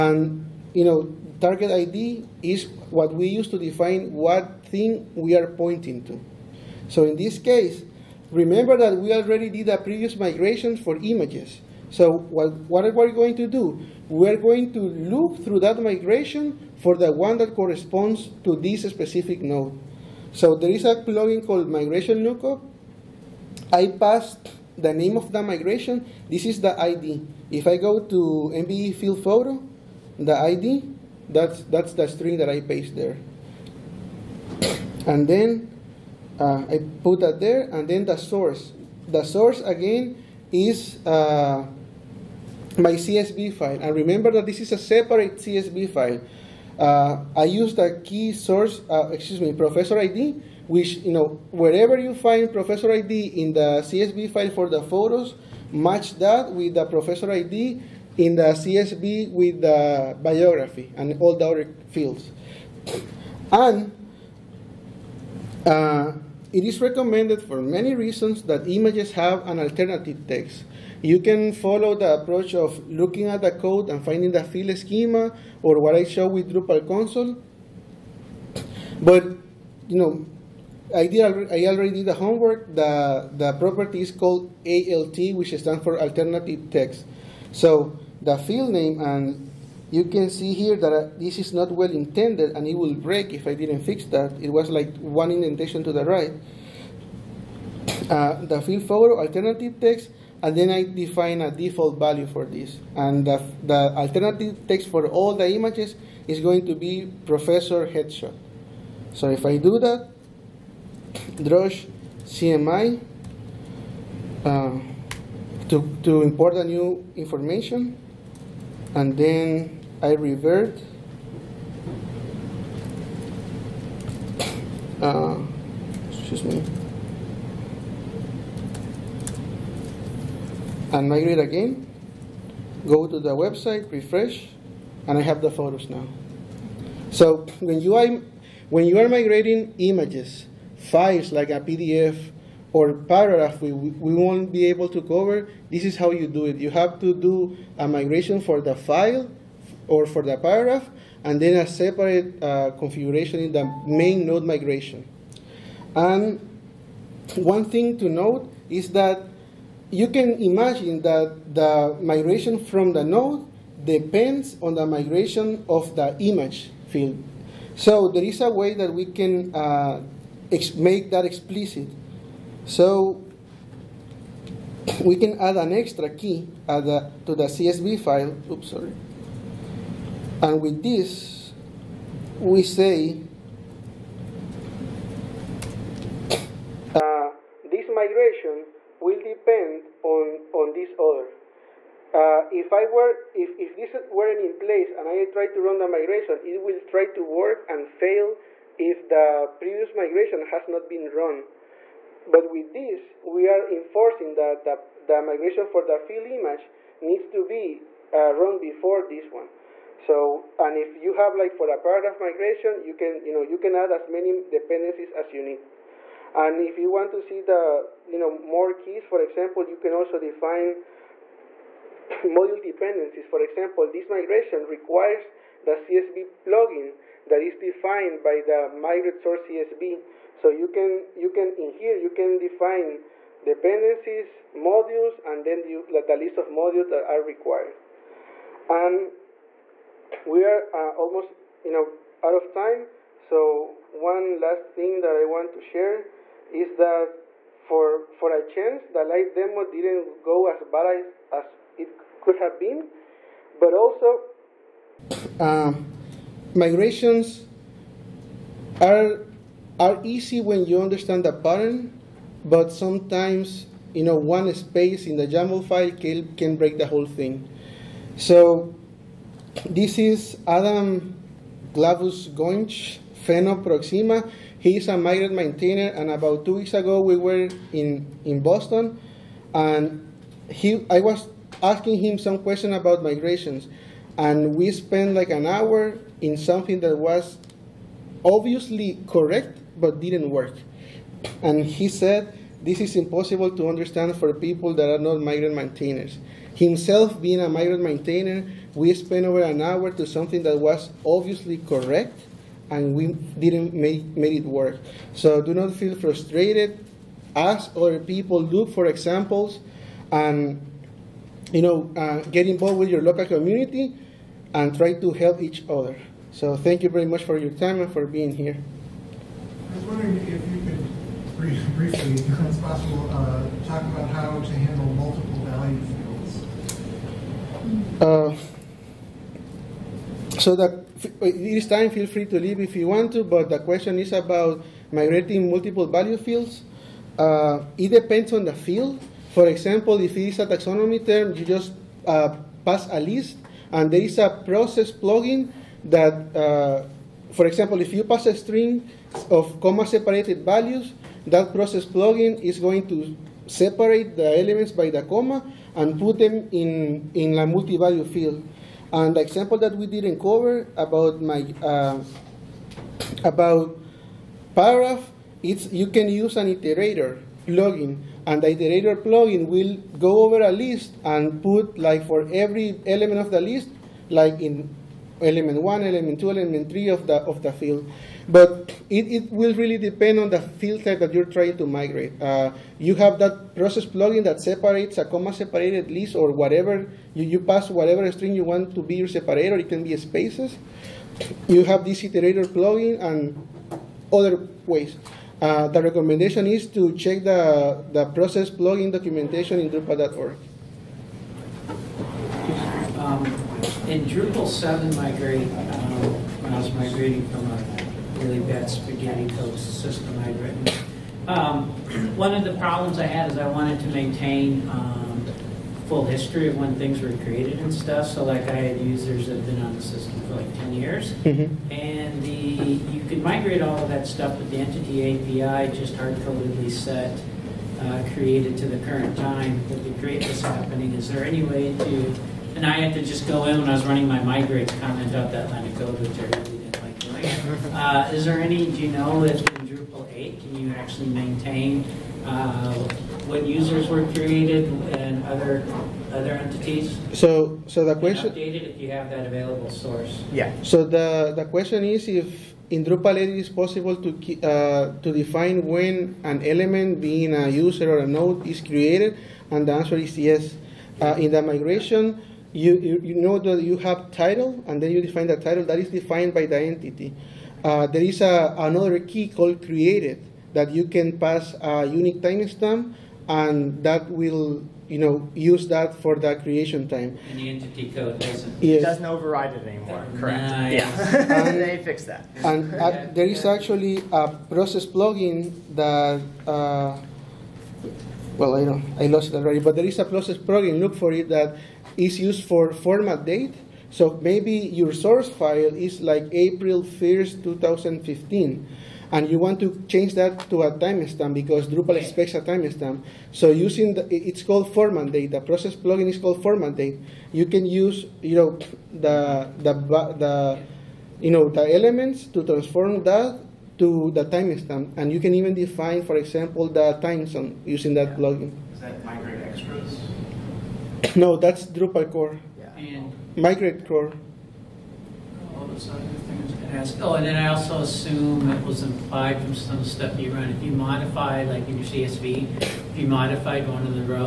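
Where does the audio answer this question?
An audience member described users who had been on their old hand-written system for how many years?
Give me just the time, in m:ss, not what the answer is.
7:00.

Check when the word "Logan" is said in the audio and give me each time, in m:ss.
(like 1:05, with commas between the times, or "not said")
not said.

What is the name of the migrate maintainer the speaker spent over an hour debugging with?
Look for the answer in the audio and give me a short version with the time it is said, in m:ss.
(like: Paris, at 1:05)
Adam Globus-Hoenich, at 4:30.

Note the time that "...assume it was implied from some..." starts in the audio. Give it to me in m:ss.
8:47.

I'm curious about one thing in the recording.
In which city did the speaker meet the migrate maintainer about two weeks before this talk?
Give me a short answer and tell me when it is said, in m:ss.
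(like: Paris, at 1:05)
Boston, at 4:38.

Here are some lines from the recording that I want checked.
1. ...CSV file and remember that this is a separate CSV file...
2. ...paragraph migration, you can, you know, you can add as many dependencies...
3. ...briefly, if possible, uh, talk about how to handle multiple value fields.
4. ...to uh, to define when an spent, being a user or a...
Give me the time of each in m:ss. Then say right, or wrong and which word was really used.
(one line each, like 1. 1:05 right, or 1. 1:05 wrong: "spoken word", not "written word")
1. 0:42 right
2. 3:31 right
3. 5:21 right
4. 7:33 wrong: "element", not "spent".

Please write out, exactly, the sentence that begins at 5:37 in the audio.
Uh, it depends on the field.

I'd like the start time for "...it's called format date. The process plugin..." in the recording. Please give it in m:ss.
8:24.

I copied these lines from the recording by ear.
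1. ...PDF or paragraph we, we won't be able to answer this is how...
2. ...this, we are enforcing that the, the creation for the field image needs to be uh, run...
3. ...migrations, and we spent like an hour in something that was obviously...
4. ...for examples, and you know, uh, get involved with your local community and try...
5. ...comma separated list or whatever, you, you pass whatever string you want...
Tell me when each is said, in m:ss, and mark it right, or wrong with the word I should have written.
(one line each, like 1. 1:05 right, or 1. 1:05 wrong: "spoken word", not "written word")
1. 2:21 wrong: "cover", not "answer"
2. 3:22 wrong: "migration", not "creation"
3. 4:43 right
4. 5:08 right
5. 6:25 right.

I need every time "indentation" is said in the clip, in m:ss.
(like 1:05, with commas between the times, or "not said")
1:35.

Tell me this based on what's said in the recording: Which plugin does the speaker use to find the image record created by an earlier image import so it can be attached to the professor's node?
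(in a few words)
Migration Lookup.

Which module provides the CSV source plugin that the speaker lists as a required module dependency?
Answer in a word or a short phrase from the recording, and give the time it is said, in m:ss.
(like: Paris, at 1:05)
migrate source CSV, at 3:48.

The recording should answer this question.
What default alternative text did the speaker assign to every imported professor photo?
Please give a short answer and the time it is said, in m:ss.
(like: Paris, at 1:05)
professor headshot, at 1:47.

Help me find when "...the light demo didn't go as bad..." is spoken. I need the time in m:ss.
4:08.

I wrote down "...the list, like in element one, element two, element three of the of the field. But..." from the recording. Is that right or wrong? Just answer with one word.
right.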